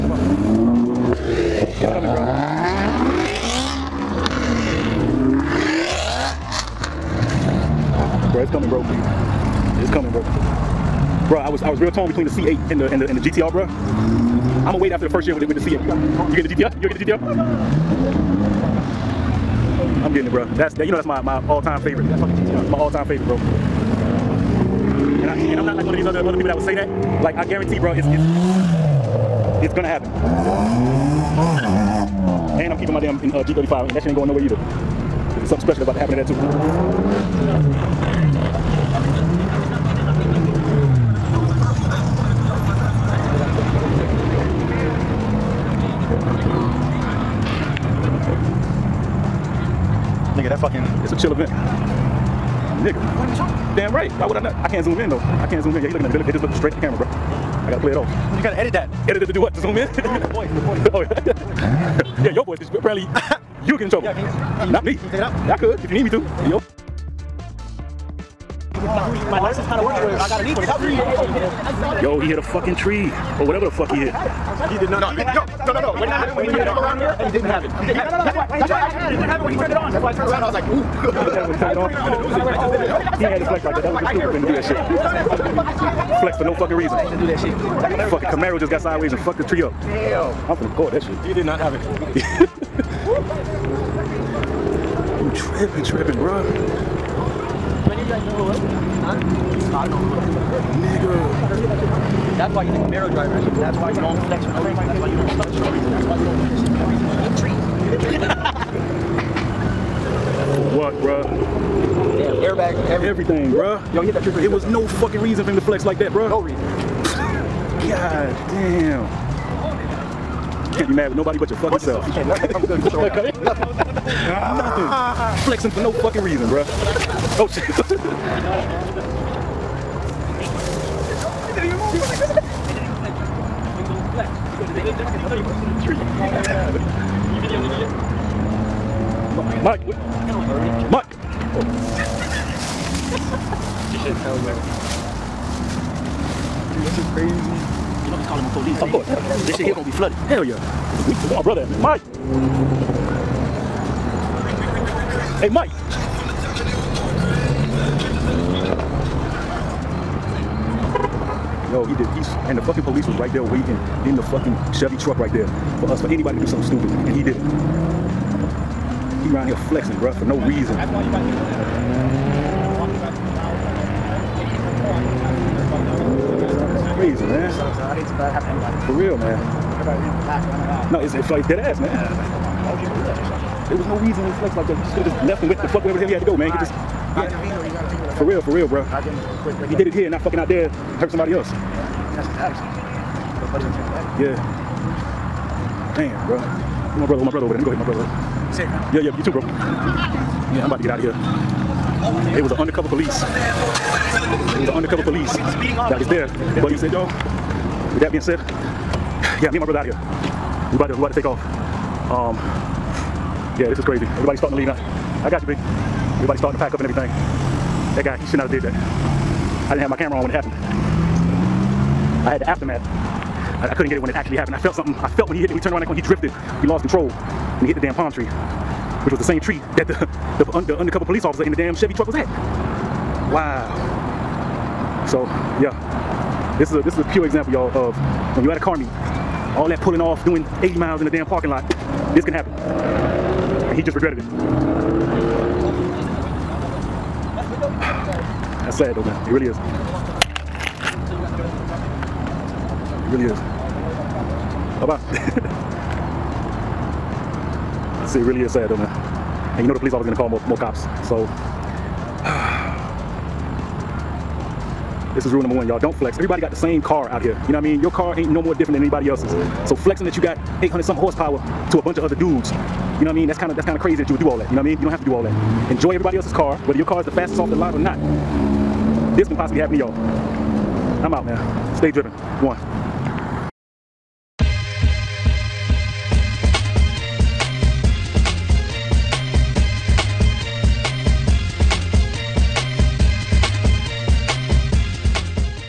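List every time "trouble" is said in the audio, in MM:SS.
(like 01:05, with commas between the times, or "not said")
01:03.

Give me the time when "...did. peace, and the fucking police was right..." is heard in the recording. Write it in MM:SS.
02:42.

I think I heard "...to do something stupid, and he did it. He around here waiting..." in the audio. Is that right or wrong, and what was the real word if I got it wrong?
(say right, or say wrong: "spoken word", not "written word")
wrong: "flexing", not "waiting".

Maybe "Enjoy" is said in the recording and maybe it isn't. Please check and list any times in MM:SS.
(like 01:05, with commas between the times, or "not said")
04:35.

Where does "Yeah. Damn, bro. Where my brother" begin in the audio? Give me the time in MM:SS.
03:14.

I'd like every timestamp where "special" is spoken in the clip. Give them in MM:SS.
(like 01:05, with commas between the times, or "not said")
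00:35.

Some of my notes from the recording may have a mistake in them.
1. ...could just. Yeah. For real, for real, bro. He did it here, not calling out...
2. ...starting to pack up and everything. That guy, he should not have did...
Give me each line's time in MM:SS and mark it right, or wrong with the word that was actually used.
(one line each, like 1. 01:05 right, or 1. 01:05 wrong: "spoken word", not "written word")
1. 03:06 wrong: "fucking", not "calling"
2. 03:36 right.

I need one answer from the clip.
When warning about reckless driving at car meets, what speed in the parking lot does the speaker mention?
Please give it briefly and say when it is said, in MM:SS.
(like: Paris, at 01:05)
80 miles, at 04:00.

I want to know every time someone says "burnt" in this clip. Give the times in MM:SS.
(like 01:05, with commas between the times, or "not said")
not said.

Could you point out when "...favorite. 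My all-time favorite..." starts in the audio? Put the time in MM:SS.
00:21.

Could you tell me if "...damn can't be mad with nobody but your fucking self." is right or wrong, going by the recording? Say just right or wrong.
right.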